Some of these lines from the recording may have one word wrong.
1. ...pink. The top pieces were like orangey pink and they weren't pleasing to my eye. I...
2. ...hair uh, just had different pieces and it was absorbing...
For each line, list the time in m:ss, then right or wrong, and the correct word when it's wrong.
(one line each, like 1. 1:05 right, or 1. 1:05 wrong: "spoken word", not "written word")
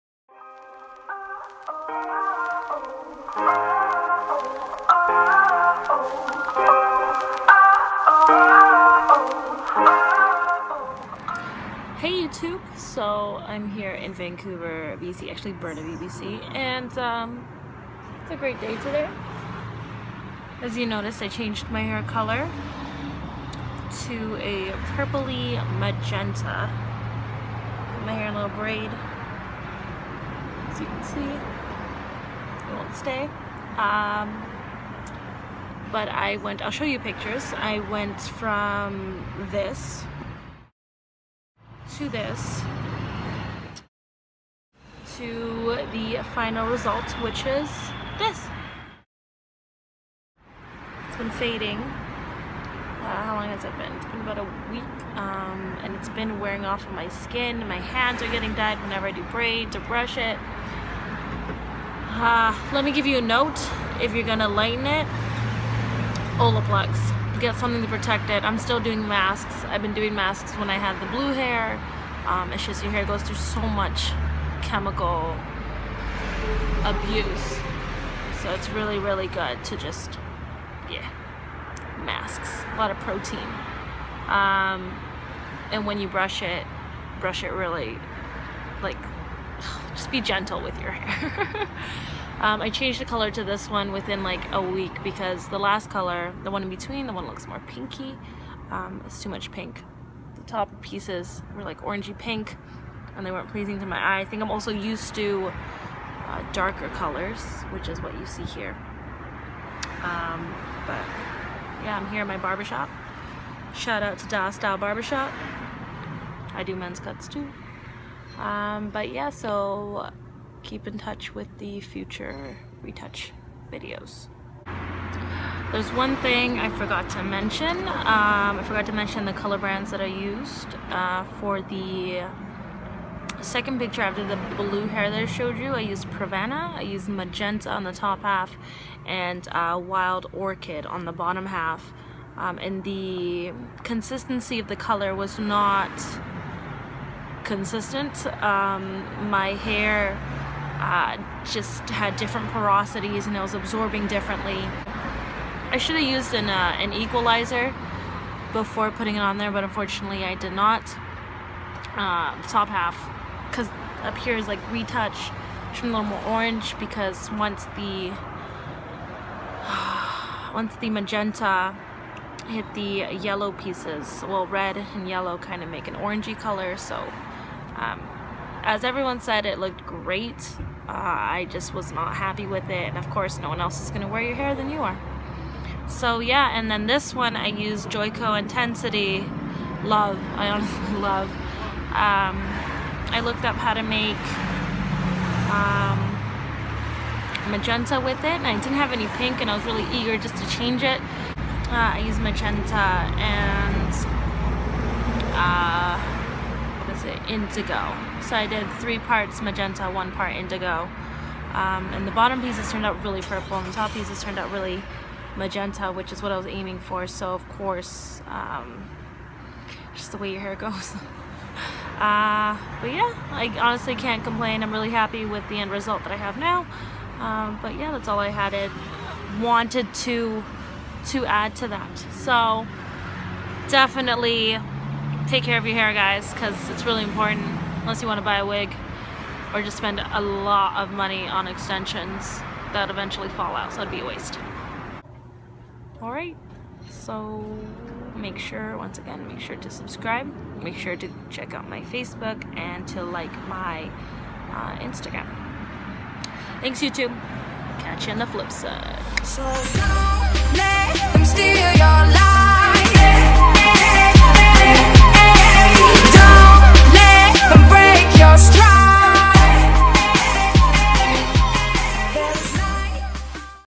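1. 1:39 right
2. 2:29 wrong: "porosities", not "pieces".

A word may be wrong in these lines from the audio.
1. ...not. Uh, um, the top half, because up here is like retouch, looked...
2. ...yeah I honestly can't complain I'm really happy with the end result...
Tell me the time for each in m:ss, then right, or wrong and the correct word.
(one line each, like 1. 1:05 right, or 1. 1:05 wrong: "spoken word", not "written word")
1. 2:40 wrong: "turned", not "looked"
2. 3:42 right.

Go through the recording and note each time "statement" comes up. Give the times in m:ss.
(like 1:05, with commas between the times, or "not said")
not said.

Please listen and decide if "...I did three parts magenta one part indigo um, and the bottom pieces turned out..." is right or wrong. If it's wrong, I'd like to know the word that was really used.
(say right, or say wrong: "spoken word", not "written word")
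right.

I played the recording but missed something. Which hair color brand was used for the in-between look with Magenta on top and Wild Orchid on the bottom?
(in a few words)
Pravana.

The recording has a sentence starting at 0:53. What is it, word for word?
It's been about a week, um, and it's been wearing off of my skin.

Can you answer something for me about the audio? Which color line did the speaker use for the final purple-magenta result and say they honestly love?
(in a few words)
Joico Intensity.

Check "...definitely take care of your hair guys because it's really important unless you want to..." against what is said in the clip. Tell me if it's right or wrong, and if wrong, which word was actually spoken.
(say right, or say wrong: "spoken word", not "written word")
right.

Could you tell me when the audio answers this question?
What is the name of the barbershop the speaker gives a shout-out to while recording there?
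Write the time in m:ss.
1:54.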